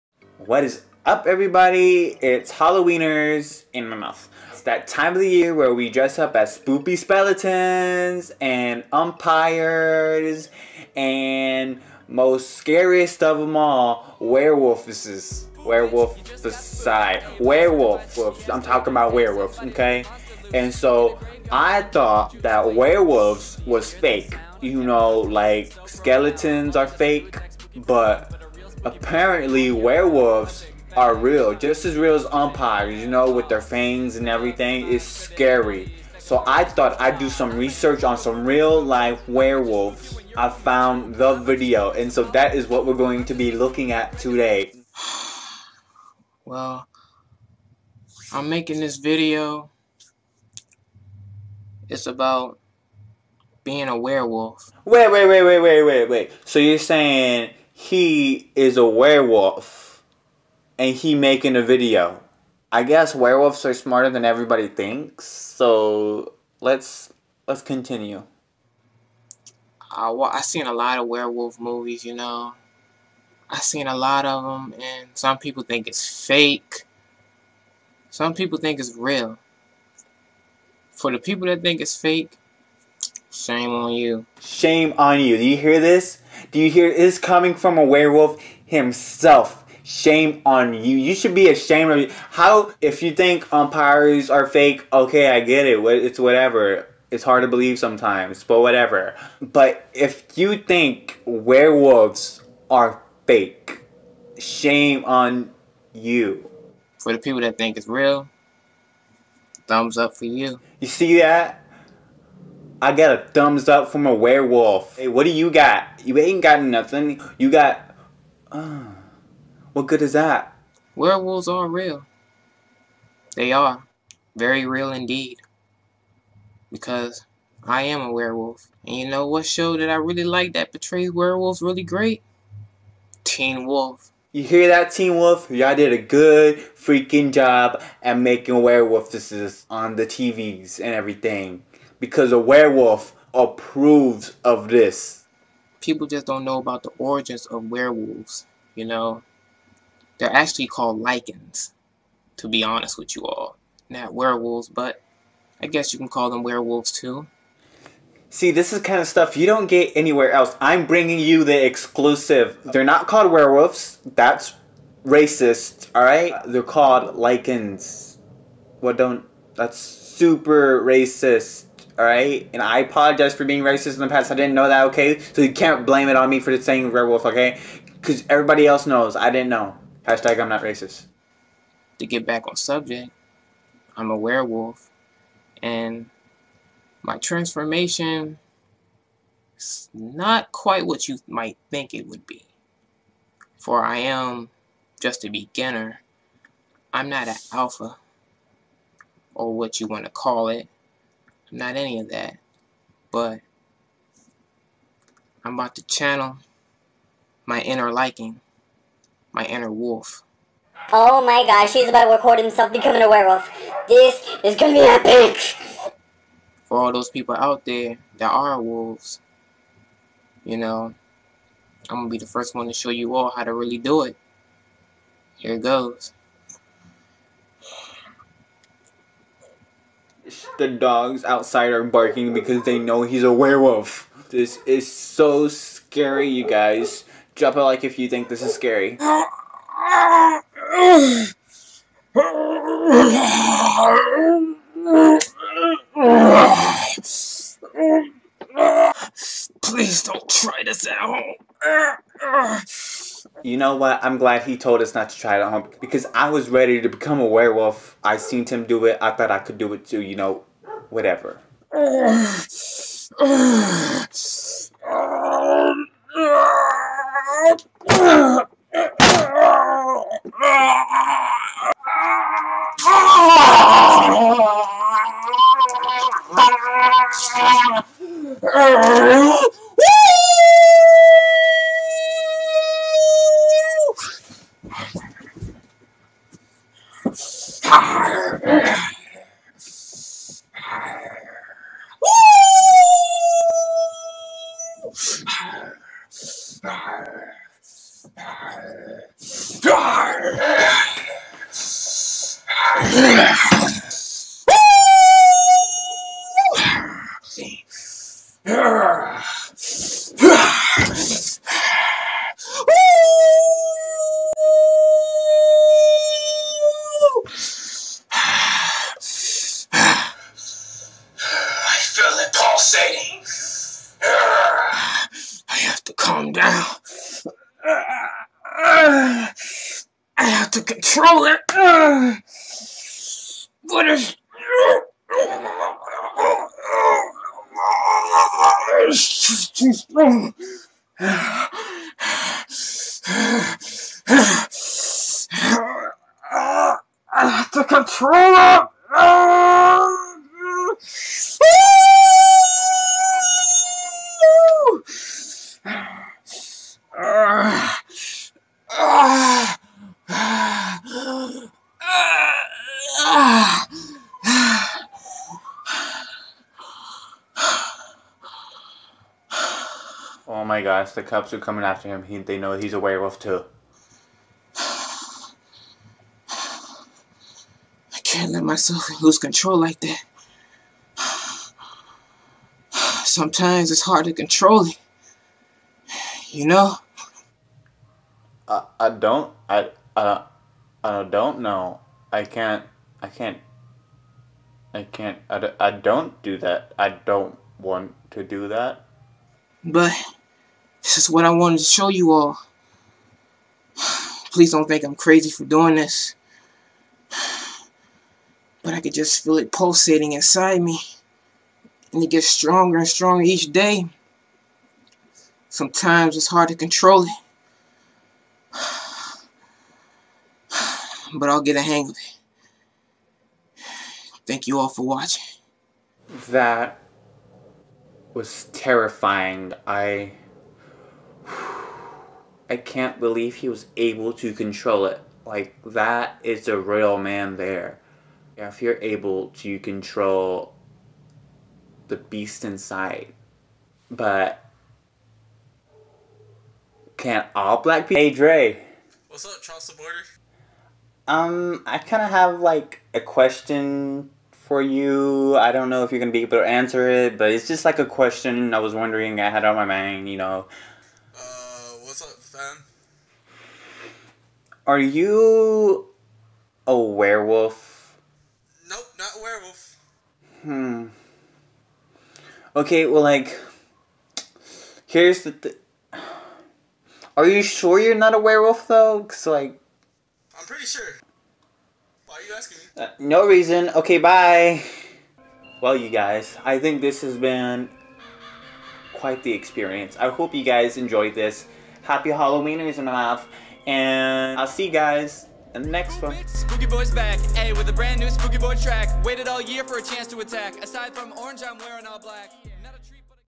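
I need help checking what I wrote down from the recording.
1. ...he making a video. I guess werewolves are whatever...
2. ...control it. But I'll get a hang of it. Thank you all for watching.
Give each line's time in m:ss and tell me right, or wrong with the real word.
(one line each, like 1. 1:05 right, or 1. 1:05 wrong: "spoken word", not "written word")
1. 1:00 wrong: "smarter", not "whatever"
2. 6:56 right.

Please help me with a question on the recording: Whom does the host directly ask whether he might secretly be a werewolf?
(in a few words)
Dre.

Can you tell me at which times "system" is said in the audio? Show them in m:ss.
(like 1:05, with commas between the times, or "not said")
not said.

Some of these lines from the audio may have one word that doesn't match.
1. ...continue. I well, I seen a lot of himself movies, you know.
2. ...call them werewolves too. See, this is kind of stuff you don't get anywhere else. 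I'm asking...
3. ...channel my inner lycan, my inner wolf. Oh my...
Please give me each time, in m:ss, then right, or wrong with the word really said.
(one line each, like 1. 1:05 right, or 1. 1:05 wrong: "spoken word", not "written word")
1. 1:07 wrong: "werewolf", not "himself"
2. 2:36 wrong: "bringing", not "asking"
3. 3:25 right.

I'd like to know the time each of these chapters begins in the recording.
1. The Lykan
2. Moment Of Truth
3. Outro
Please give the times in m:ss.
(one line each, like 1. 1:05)
1. 0:50
2. 3:45
3. 8:06.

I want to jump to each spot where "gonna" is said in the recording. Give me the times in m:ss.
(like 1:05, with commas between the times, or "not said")
3:34, 3:41, 7:36.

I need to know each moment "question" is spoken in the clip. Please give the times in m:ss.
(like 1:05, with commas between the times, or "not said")
7:32, 7:37.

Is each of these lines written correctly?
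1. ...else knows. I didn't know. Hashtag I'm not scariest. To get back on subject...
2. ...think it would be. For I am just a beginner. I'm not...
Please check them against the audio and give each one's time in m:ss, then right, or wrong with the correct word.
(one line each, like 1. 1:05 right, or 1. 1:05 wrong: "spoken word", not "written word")
1. 2:58 wrong: "racist", not "scariest"
2. 3:11 right.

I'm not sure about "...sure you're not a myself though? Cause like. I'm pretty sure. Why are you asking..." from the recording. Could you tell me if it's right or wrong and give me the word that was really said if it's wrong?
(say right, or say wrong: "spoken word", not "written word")
wrong: "werewolf", not "myself".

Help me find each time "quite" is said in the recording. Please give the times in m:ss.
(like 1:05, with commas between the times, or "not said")
3:10, 8:08.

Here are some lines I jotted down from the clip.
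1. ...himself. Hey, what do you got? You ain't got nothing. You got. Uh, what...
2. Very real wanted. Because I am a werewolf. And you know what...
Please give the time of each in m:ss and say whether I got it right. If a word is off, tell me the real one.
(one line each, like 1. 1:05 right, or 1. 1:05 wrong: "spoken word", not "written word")
1. 1:54 wrong: "werewolf", not "himself"
2. 2:04 wrong: "indeed", not "wanted".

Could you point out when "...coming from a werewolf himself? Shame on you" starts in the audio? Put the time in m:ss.
1:27.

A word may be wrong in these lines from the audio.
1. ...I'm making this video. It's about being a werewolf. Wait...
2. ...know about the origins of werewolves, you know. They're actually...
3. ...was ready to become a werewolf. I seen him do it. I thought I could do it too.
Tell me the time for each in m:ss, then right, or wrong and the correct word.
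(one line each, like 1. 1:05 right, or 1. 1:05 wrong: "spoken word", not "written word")
1. 0:48 right
2. 2:26 right
3. 4:16 right.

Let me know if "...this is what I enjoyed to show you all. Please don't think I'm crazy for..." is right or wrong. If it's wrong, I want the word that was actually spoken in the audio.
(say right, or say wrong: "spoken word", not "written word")
wrong: "wanted", not "enjoyed".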